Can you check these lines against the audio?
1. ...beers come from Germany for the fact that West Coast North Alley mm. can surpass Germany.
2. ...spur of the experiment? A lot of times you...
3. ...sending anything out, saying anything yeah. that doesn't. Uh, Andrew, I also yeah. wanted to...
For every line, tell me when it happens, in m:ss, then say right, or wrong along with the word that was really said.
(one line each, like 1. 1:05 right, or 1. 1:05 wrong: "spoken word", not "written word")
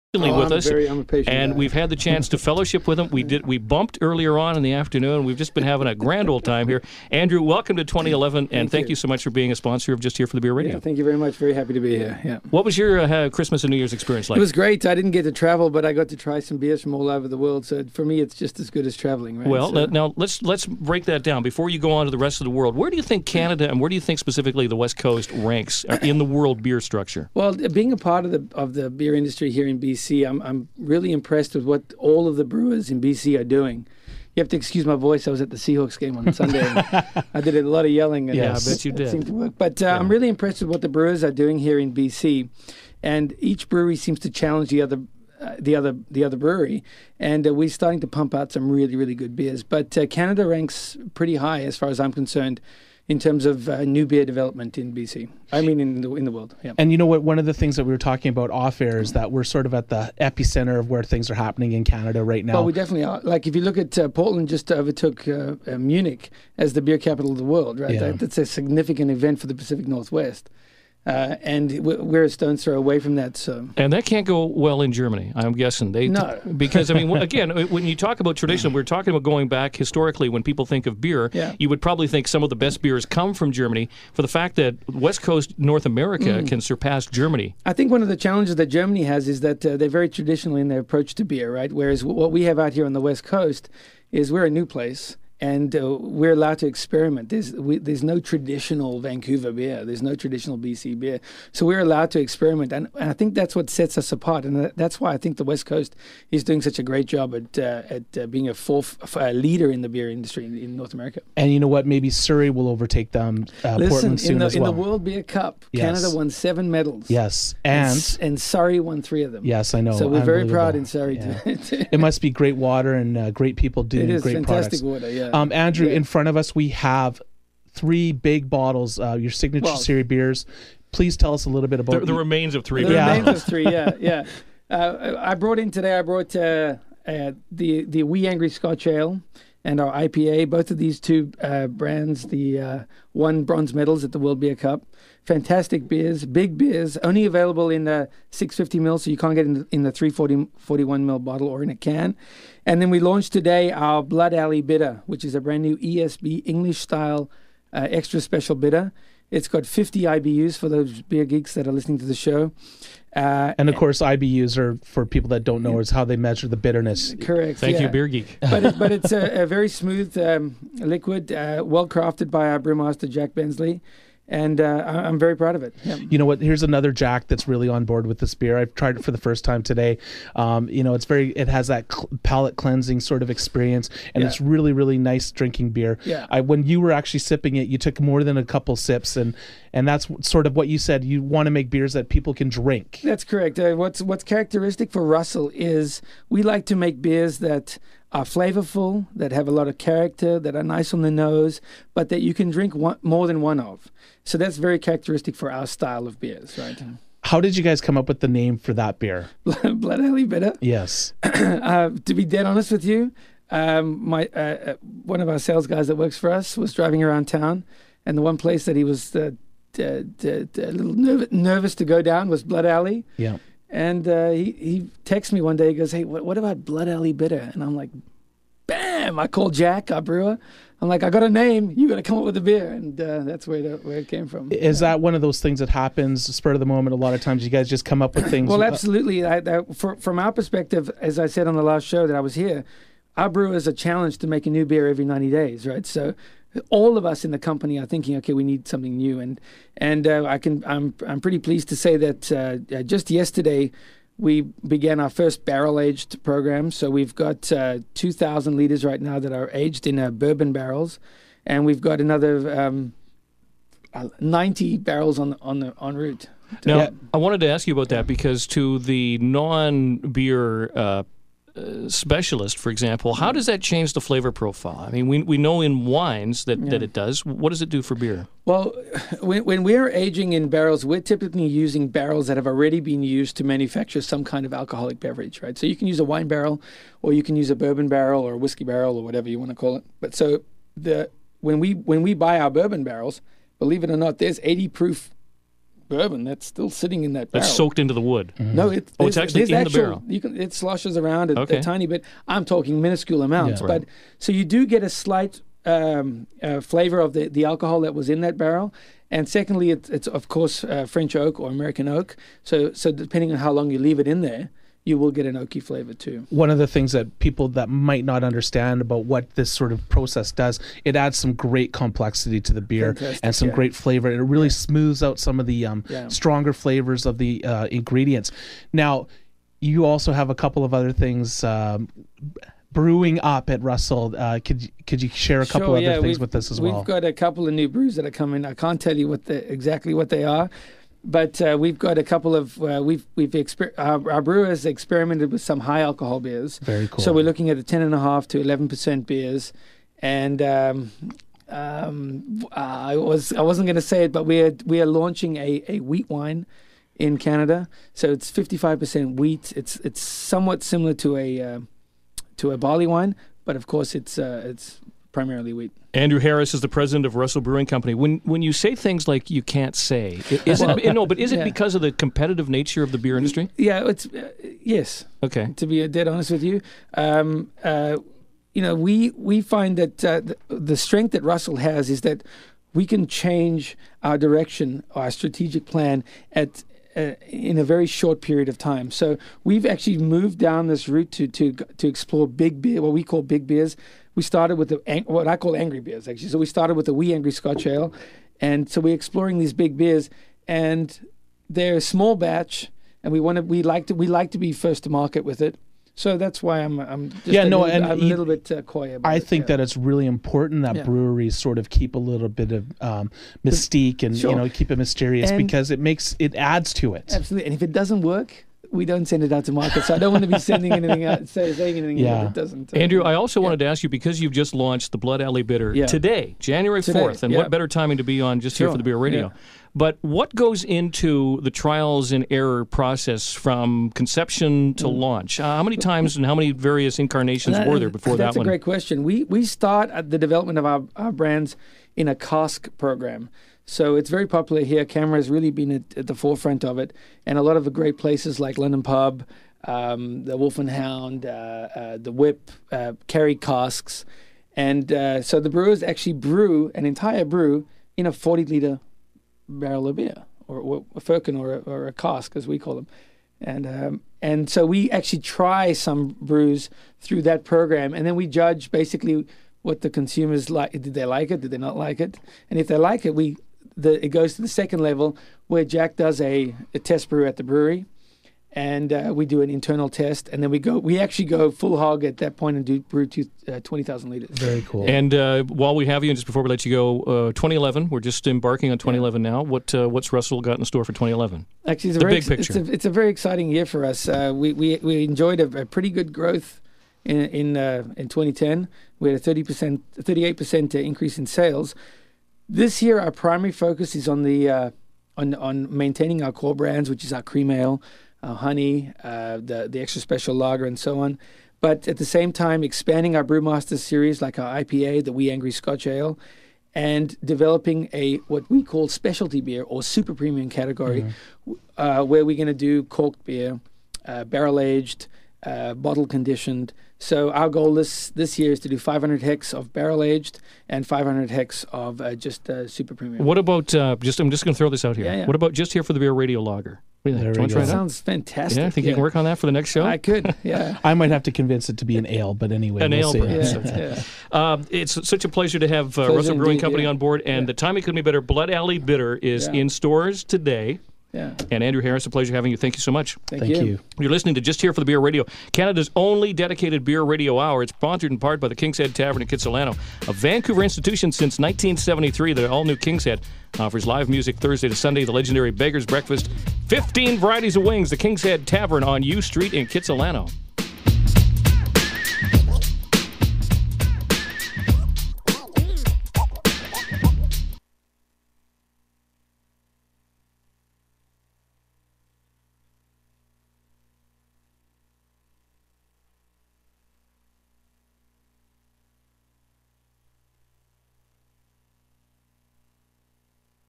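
1. 1:22 wrong: "America", not "Alley"
2. 3:56 wrong: "moment", not "experiment"
3. 7:00 right.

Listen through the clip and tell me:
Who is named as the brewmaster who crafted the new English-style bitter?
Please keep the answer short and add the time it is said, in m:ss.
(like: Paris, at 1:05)
Jack Bensley, at 2:53.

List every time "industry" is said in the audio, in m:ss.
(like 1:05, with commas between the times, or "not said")
0:29, 1:50, 6:13.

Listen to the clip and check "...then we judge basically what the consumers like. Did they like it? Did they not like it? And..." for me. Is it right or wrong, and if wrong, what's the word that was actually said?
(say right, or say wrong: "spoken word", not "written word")
right.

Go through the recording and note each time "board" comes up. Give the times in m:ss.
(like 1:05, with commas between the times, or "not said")
2:57, 9:06.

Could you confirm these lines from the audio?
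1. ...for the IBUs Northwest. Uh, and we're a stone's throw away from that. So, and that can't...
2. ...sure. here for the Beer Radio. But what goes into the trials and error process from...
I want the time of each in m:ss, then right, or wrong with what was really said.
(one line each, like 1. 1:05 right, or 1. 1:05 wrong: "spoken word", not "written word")
1. 1:09 wrong: "Pacific", not "IBUs"
2. 7:08 right.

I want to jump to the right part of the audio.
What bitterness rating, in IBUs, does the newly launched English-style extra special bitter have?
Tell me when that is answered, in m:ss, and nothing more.
2:39.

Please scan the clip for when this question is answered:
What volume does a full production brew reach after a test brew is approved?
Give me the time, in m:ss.
8:03.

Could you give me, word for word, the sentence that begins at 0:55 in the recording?
I mean, in the in the world.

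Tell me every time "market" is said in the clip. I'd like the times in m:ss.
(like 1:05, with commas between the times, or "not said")
6:44, 6:59.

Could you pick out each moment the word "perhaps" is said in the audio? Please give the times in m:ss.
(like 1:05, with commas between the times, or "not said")
not said.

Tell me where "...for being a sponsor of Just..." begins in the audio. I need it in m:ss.
0:09.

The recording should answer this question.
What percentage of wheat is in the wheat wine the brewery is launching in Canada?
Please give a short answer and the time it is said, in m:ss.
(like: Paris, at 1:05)
55 percent, at 5:58.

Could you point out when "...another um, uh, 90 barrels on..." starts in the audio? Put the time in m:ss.
4:21.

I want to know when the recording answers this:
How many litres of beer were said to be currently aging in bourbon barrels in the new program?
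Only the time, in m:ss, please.
4:17.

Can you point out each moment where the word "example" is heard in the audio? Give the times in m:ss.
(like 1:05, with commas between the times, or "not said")
4:32.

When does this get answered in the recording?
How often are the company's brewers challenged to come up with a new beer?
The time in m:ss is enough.
4:04.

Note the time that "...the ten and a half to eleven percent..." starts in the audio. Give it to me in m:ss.
5:47.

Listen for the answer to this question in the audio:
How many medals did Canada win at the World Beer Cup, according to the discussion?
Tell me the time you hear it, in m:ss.
1:56.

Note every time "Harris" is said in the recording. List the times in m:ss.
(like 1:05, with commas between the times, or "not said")
6:06, 9:11.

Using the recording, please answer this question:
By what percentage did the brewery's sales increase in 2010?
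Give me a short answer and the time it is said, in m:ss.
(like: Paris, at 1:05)
38 percent, at 8:19.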